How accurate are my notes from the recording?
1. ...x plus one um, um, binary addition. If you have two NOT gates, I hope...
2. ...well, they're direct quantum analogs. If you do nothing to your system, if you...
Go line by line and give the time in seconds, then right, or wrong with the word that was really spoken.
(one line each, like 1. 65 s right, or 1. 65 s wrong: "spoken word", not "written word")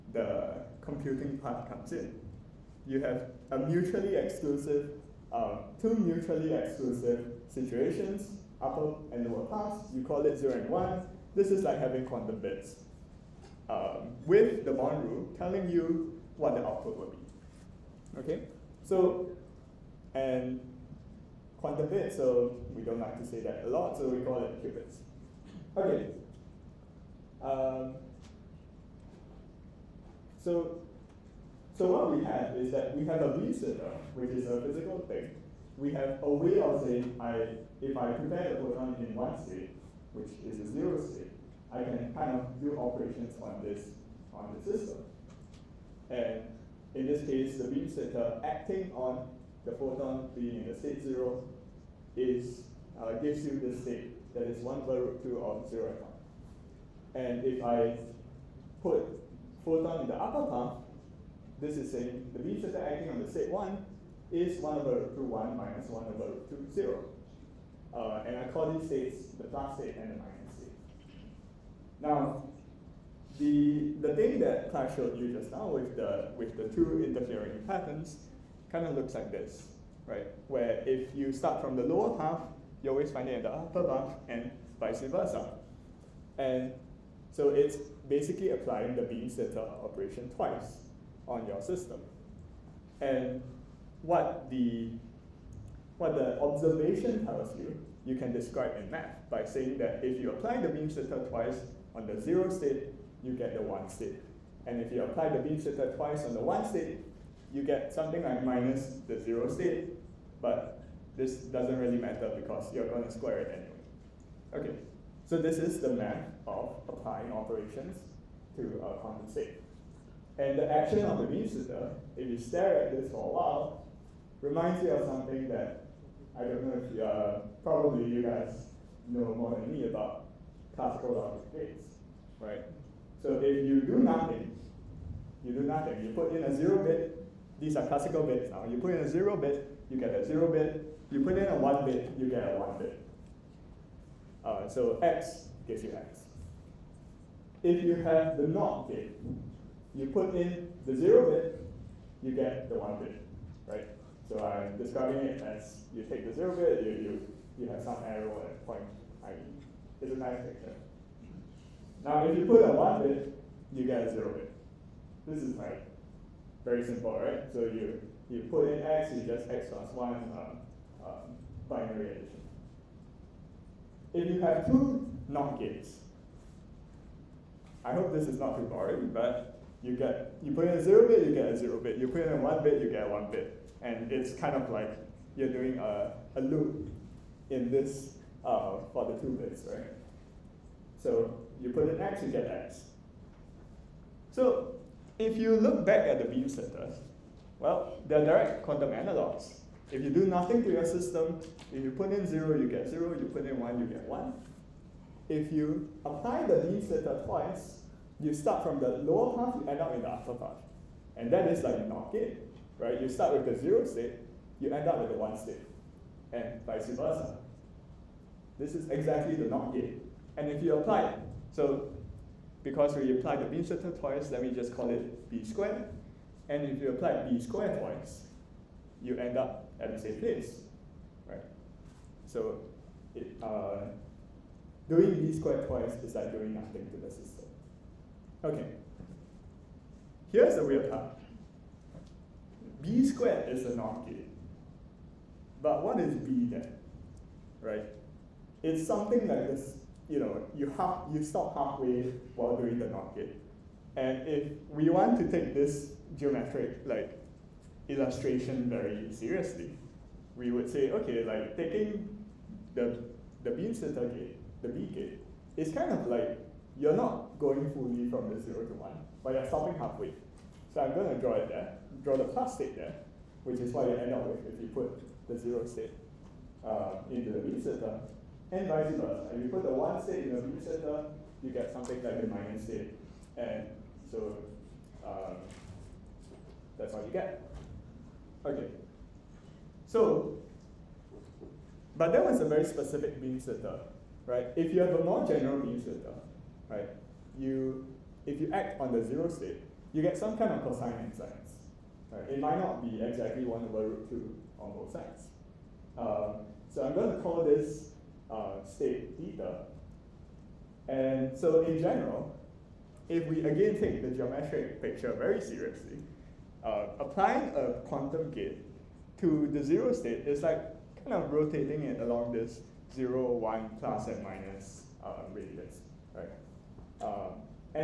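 1. 169 s right
2. 197 s right.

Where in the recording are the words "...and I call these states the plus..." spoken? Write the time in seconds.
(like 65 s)
68 s.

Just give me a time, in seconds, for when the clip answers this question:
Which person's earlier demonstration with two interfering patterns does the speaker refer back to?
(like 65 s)
74 s.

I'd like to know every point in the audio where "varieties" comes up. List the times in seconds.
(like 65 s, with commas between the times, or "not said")
not said.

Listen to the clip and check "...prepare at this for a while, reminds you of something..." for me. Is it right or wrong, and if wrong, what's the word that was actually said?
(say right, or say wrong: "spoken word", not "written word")
wrong: "stare", not "prepare".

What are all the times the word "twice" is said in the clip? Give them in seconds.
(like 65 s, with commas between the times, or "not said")
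90 s, 101 s, 105 s, 207 s, 223 s, 227 s, 235 s.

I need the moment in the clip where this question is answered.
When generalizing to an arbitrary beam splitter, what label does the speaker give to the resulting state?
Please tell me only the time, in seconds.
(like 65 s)
308 s.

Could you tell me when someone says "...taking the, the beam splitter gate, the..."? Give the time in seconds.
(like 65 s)
261 s.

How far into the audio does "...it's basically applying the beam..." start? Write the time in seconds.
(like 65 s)
87 s.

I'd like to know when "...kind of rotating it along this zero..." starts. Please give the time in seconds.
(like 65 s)
321 s.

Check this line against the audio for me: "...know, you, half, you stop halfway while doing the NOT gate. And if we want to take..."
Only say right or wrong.
right.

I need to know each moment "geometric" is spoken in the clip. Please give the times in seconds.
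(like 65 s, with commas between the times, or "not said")
256 s, 314 s.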